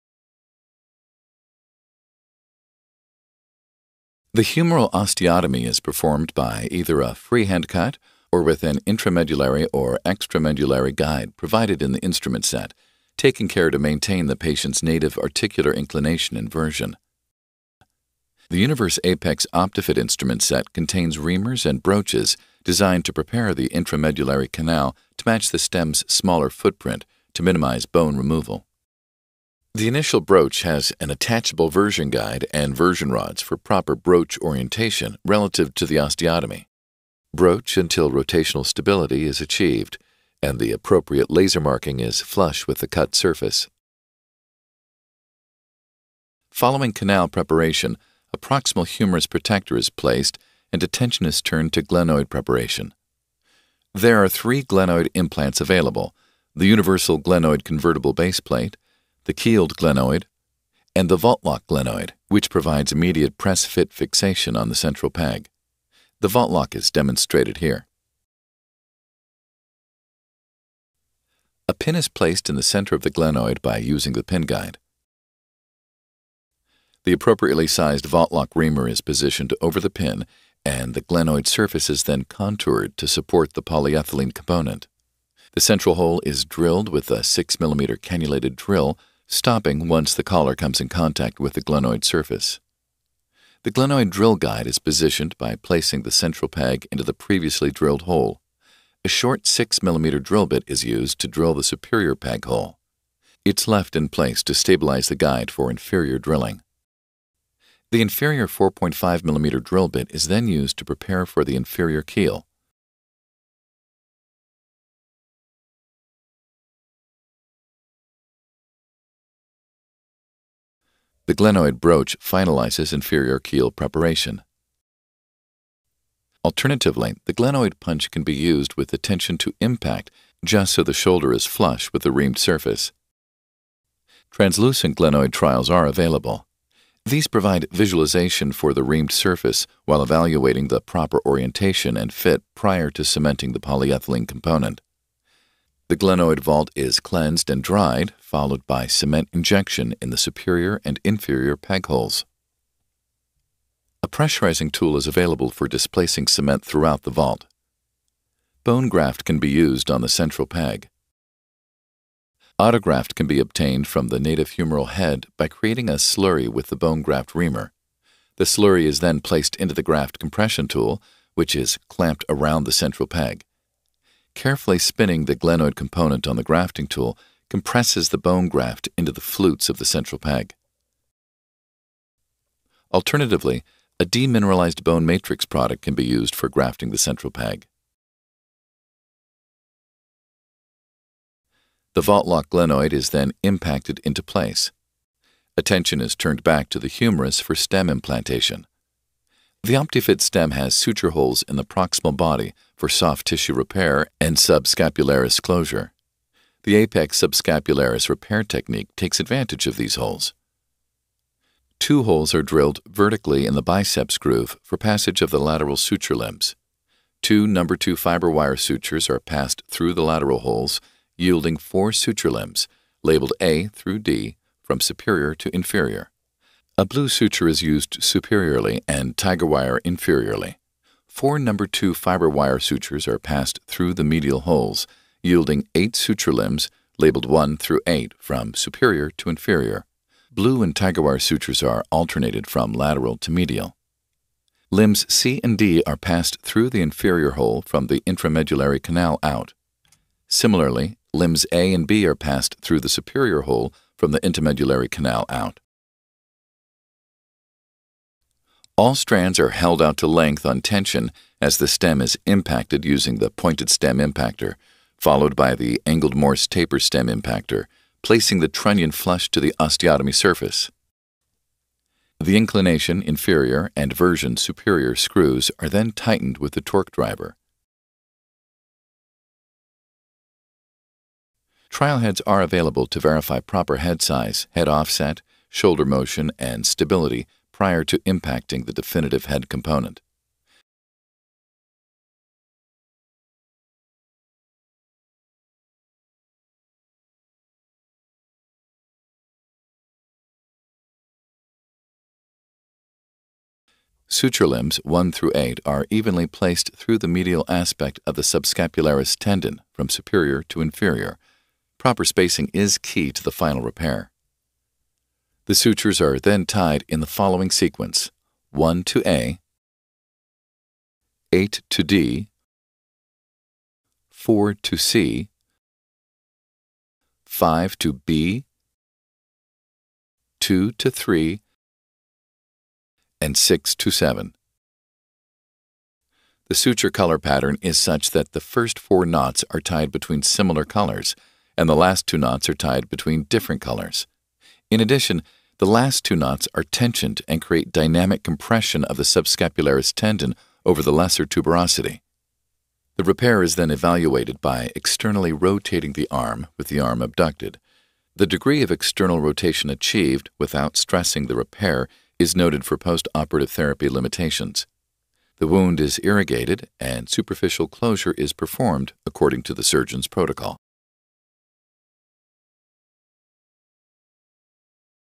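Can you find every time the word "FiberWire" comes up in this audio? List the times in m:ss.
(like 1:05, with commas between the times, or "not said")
3:37, 3:51.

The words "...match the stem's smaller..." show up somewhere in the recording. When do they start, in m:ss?
0:25.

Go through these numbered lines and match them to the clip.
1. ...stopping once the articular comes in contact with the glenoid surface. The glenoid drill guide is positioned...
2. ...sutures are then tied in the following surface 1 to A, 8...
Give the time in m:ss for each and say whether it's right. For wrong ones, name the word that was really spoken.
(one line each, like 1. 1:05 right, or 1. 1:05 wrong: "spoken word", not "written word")
1. 1:29 wrong: "collar", not "articular"
2. 5:15 wrong: "sequence", not "surface".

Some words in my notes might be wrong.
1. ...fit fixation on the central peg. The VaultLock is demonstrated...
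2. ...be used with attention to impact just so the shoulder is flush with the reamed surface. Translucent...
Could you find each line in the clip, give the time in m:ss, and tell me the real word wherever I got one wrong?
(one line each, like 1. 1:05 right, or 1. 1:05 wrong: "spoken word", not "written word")
1. 1:03 right
2. 2:08 right.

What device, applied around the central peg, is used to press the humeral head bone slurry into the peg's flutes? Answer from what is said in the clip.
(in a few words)
graft compression tool.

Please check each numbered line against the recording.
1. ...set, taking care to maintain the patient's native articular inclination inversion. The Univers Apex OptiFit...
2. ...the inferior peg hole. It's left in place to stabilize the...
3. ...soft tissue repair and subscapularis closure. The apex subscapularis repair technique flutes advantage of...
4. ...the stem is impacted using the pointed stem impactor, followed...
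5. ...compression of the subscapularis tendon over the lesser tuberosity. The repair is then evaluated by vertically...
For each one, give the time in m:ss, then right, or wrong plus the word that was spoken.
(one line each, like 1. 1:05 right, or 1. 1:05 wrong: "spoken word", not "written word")
1. 0:12 right
2. 1:41 wrong: "superior", not "inferior"
3. 3:22 wrong: "takes", not "flutes"
4. 4:21 right
5. 5:48 wrong: "externally", not "vertically".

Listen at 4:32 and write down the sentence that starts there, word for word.
The inclination inferior and version superior screws are then tightened with the torque driver.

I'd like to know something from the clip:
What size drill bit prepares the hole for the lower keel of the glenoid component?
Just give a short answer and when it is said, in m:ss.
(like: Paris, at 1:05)
4.5 mm, at 1:48.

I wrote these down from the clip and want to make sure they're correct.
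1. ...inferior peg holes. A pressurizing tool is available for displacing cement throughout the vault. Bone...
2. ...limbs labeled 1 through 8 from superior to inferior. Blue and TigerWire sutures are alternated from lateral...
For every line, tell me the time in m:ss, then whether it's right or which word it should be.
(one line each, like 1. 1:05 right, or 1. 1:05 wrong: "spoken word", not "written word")
1. 2:31 right
2. 3:56 right.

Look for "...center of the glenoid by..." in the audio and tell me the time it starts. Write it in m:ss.
1:12.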